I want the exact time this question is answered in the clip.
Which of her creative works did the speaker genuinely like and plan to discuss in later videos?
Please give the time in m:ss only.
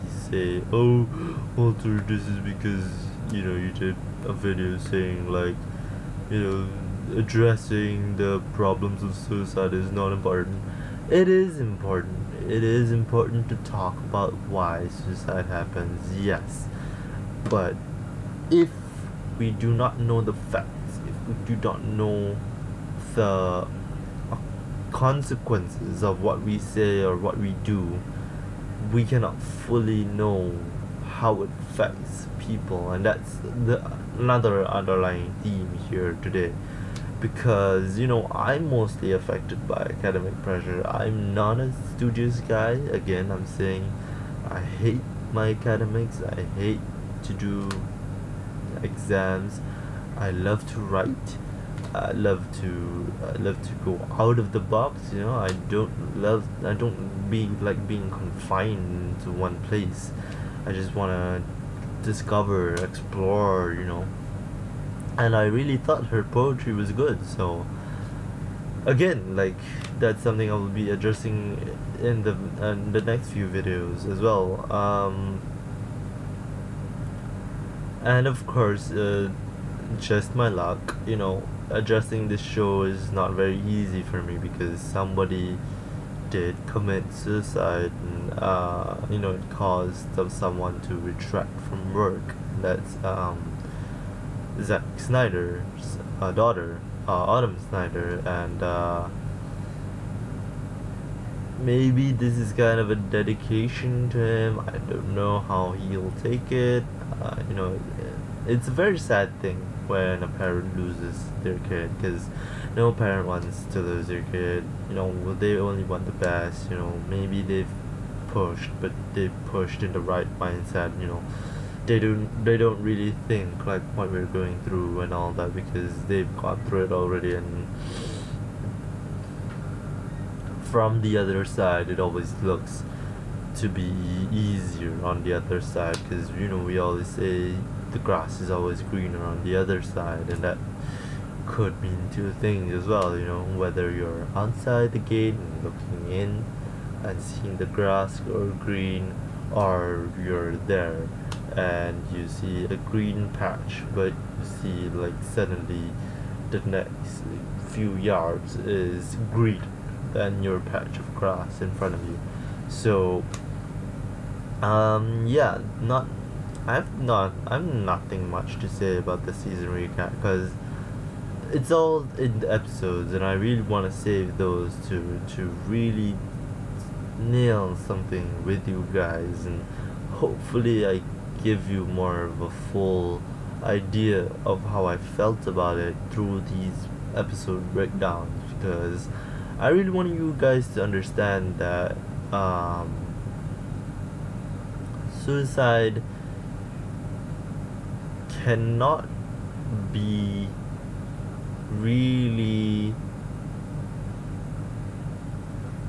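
1:06.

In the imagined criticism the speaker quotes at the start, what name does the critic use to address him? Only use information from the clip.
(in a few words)
Walter.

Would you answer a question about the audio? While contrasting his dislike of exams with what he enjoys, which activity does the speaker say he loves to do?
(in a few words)
Write.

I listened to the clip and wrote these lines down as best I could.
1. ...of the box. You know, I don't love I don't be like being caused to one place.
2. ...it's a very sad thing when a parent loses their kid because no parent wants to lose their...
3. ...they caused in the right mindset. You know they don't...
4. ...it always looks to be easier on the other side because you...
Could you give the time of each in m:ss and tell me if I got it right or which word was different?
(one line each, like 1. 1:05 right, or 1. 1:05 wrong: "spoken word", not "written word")
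1. 0:54 wrong: "confined", not "caused"
2. 1:48 right
3. 1:59 wrong: "pushed", not "caused"
4. 2:11 right.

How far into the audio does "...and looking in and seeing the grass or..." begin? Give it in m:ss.
2:25.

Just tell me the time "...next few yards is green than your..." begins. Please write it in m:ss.
2:36.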